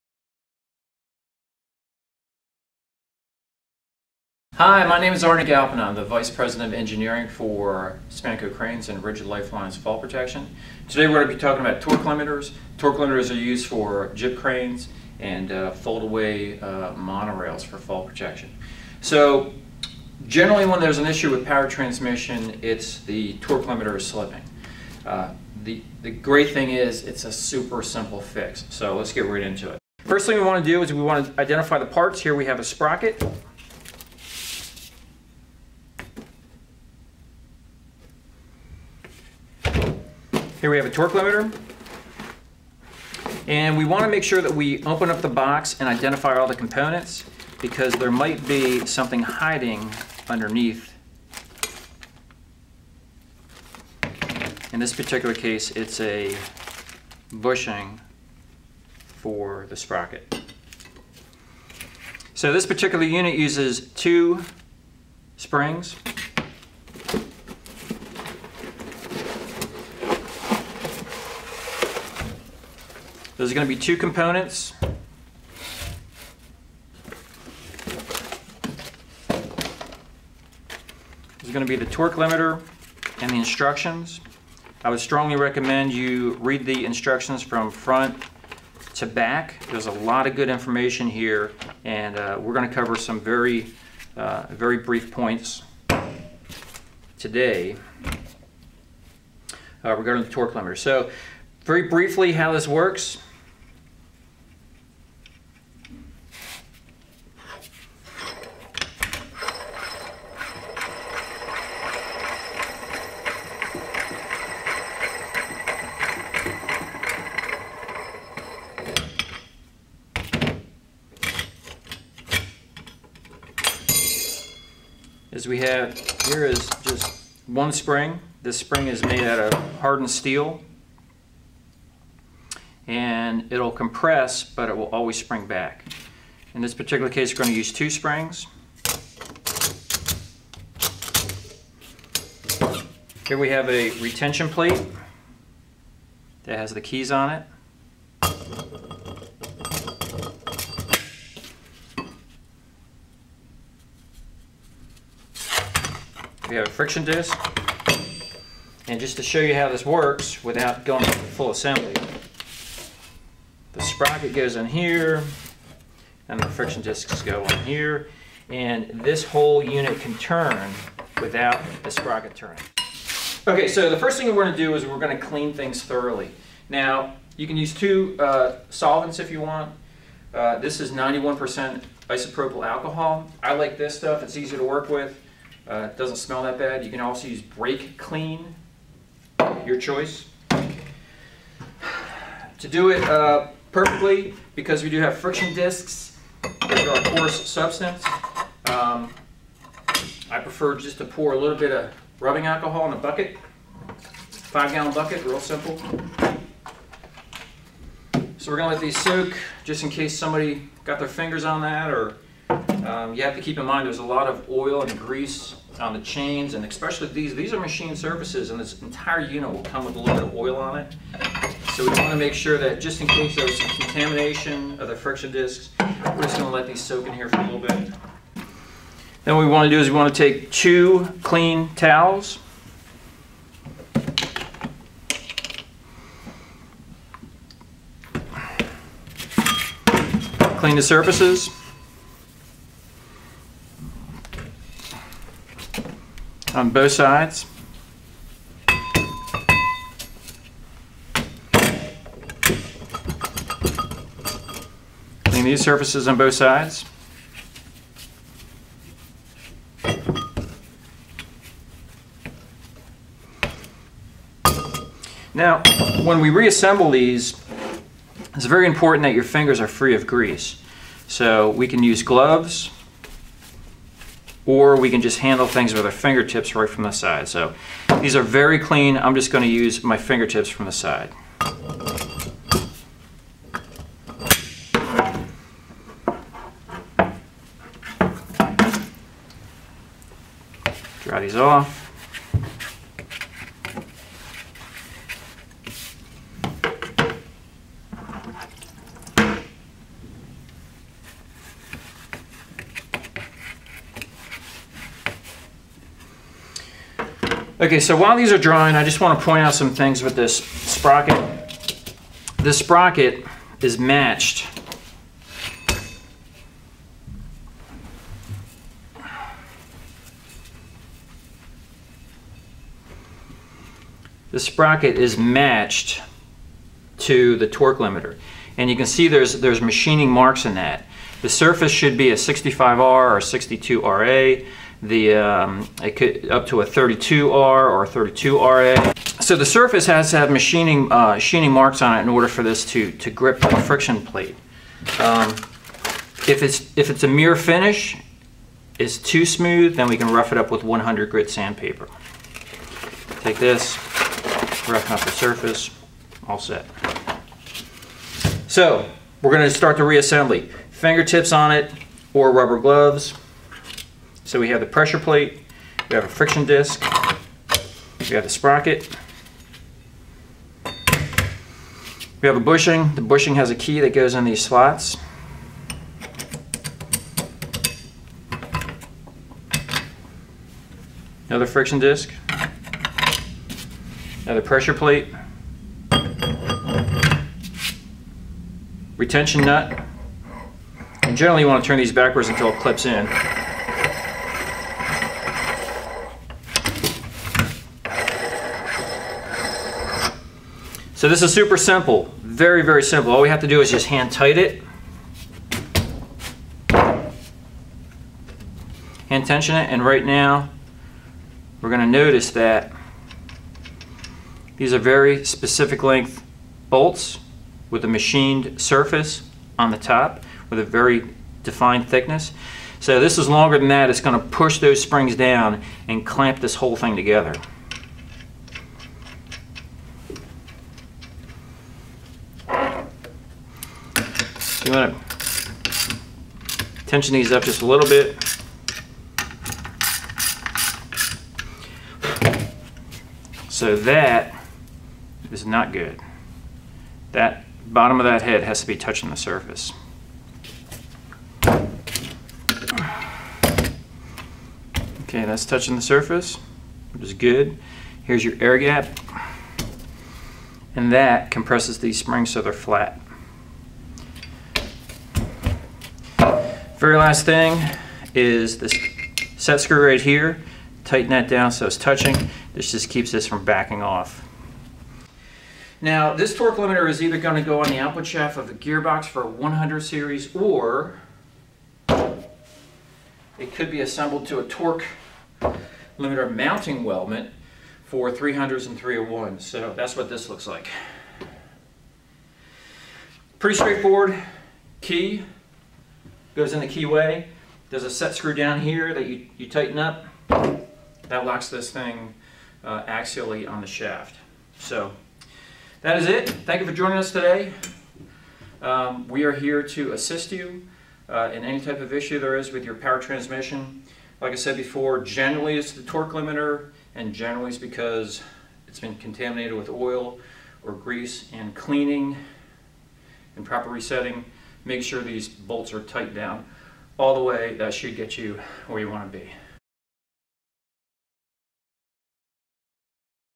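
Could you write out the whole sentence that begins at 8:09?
So that's what this looks like.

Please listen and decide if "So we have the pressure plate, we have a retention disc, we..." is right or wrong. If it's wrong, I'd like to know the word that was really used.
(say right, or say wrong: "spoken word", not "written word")
wrong: "friction", not "retention".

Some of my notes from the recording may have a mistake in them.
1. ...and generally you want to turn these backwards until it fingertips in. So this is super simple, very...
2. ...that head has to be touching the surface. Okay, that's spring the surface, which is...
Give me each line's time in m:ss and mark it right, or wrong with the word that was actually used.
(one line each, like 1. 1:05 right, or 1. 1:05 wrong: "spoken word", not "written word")
1. 6:31 wrong: "clips", not "fingertips"
2. 7:28 wrong: "touching", not "spring".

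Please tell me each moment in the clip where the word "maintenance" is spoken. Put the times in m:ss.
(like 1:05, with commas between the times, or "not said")
not said.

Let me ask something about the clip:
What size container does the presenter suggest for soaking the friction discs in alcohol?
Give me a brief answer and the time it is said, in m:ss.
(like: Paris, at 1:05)
Five gallon bucket, at 3:24.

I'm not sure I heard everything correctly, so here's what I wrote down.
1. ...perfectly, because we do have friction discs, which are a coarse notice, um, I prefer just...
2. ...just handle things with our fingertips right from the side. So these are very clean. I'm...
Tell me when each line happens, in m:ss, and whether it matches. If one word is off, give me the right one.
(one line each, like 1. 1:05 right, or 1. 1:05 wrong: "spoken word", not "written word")
1. 3:13 wrong: "substance", not "notice"
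2. 4:35 right.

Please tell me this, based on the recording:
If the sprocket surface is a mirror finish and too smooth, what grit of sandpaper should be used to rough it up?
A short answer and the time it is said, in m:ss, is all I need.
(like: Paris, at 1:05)
100, at 5:50.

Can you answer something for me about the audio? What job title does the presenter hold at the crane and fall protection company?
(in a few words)
Vice President of Engineering.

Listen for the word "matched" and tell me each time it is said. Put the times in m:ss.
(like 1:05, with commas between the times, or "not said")
5:13, 5:25.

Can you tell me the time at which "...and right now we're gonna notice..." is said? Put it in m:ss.
6:49.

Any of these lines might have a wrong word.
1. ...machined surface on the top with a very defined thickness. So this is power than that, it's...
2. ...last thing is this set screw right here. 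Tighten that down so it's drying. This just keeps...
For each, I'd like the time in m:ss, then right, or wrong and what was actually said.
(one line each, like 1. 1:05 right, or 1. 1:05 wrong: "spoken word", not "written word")
1. 6:57 wrong: "longer", not "power"
2. 7:46 wrong: "touching", not "drying".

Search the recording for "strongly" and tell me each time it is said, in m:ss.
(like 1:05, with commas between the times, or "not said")
1:24.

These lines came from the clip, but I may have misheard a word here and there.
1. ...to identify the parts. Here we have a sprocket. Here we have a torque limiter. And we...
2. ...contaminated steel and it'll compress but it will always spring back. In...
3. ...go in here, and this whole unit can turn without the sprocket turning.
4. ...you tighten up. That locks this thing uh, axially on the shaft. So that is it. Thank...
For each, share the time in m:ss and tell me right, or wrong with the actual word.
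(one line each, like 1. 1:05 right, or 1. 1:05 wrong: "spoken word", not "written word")
1. 0:31 right
2. 2:09 wrong: "hardened", not "contaminated"
3. 2:47 right
4. 8:19 right.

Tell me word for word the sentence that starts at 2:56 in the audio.
Now, you can use two uh, solvents if you want.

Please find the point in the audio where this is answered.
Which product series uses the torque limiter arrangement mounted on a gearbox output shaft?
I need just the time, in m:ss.
7:59.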